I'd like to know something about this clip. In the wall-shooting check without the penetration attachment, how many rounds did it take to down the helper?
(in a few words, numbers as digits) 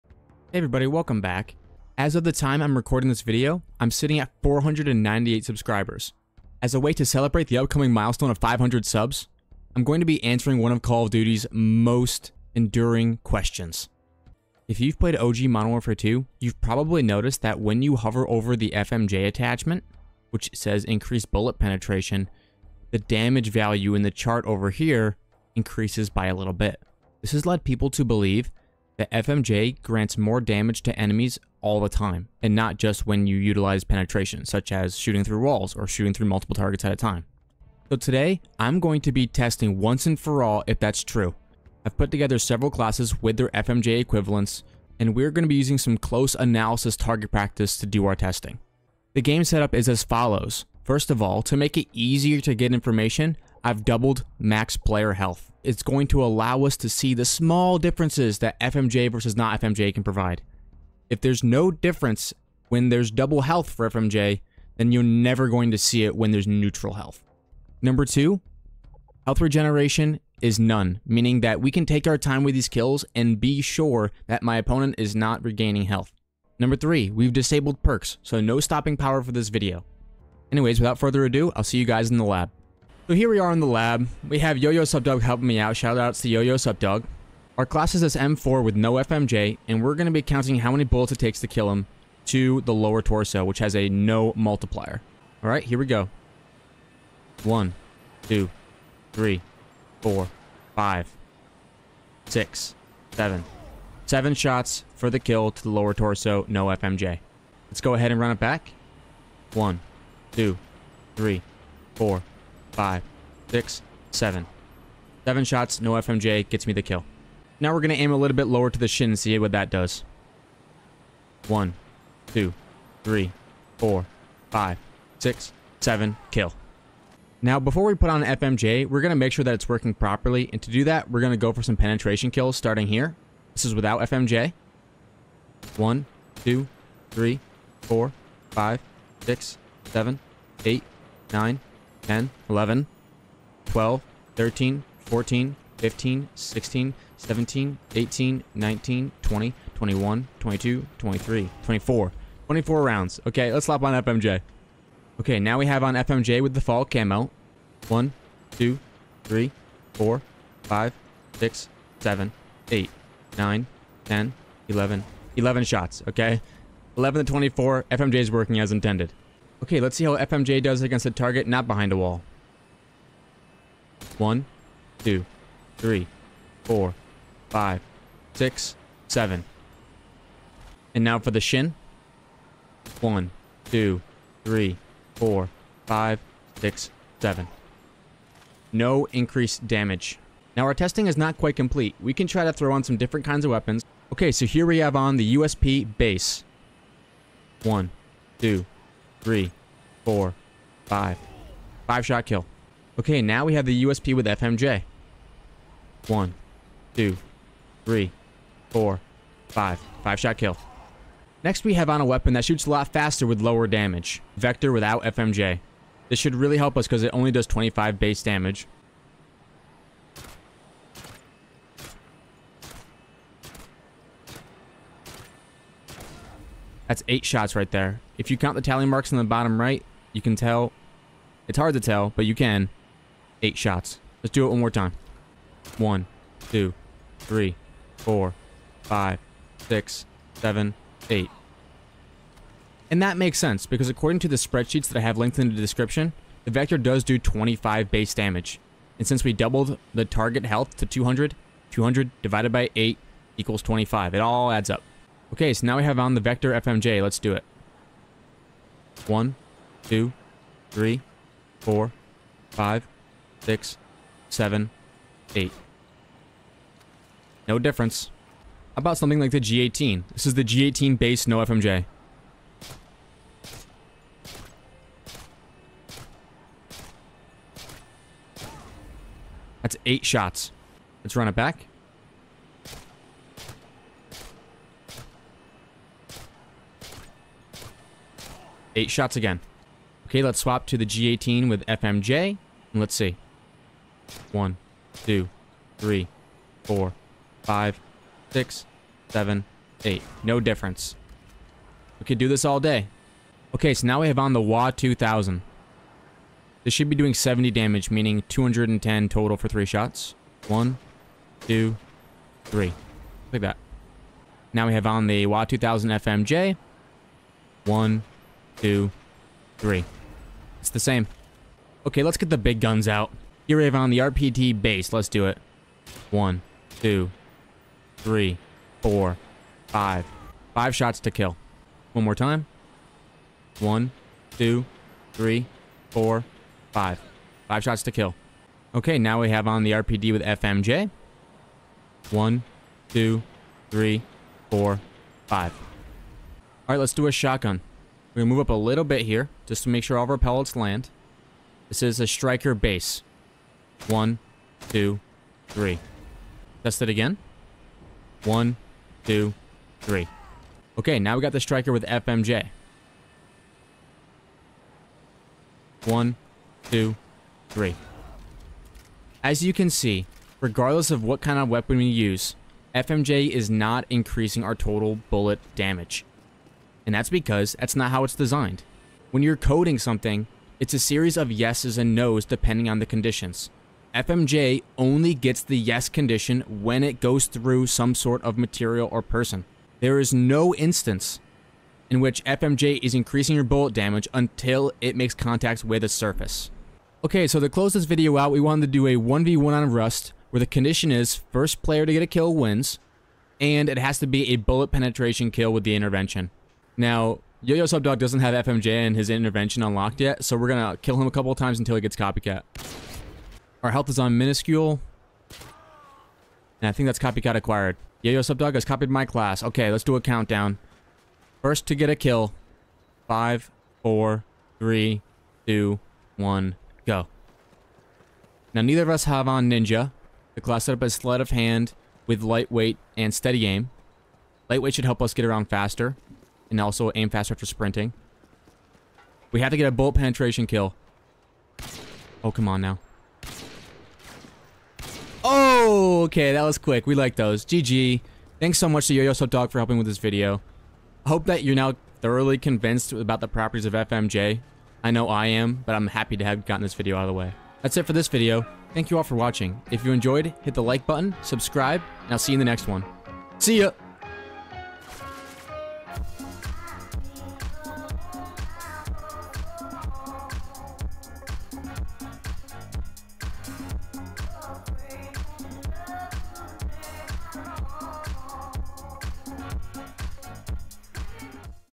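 24.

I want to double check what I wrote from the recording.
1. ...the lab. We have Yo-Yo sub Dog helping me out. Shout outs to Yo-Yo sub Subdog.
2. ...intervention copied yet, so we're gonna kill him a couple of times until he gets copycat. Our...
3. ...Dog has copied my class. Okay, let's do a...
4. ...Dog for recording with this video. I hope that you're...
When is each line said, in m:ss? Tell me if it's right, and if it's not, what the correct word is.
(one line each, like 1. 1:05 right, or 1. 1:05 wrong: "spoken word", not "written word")
1. 1:23 wrong: "Subdog", not "Dog"
2. 6:49 wrong: "unlocked", not "copied"
3. 6:58 right
4. 7:29 wrong: "helping", not "recording".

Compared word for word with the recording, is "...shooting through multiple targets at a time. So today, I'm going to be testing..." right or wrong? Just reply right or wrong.
right.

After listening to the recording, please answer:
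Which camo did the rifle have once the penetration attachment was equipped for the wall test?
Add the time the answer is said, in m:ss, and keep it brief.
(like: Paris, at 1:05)
fall camo, at 2:36.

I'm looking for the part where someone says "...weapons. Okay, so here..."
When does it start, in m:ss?
3:13.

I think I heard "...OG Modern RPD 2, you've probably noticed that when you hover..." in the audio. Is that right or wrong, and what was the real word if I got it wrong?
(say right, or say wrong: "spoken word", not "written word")
wrong: "Warfare", not "RPD".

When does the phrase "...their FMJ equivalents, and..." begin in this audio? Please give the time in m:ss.
0:43.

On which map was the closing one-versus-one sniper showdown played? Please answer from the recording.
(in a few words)
Rust.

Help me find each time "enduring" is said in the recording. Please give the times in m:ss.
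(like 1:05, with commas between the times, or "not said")
0:12.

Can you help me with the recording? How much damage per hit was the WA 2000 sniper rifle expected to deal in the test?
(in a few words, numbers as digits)
70.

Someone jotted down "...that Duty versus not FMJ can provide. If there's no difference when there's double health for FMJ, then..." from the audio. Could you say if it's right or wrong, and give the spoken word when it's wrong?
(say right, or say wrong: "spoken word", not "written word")
wrong: "FMJ", not "Duty".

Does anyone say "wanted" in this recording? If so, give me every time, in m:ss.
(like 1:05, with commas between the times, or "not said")
6:38.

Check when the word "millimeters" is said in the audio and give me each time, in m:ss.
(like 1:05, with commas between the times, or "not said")
not said.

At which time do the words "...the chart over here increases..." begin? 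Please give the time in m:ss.
0:24.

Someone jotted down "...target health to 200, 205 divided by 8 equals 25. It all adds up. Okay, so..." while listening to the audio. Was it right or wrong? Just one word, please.
wrong.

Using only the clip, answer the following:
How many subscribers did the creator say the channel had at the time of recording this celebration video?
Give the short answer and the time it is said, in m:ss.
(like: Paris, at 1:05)
498, at 0:04.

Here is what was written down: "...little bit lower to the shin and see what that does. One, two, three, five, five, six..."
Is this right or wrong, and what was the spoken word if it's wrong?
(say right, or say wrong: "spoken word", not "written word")
wrong: "four", not "five".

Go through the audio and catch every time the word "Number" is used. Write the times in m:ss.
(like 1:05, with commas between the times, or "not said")
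1:07, 1:16.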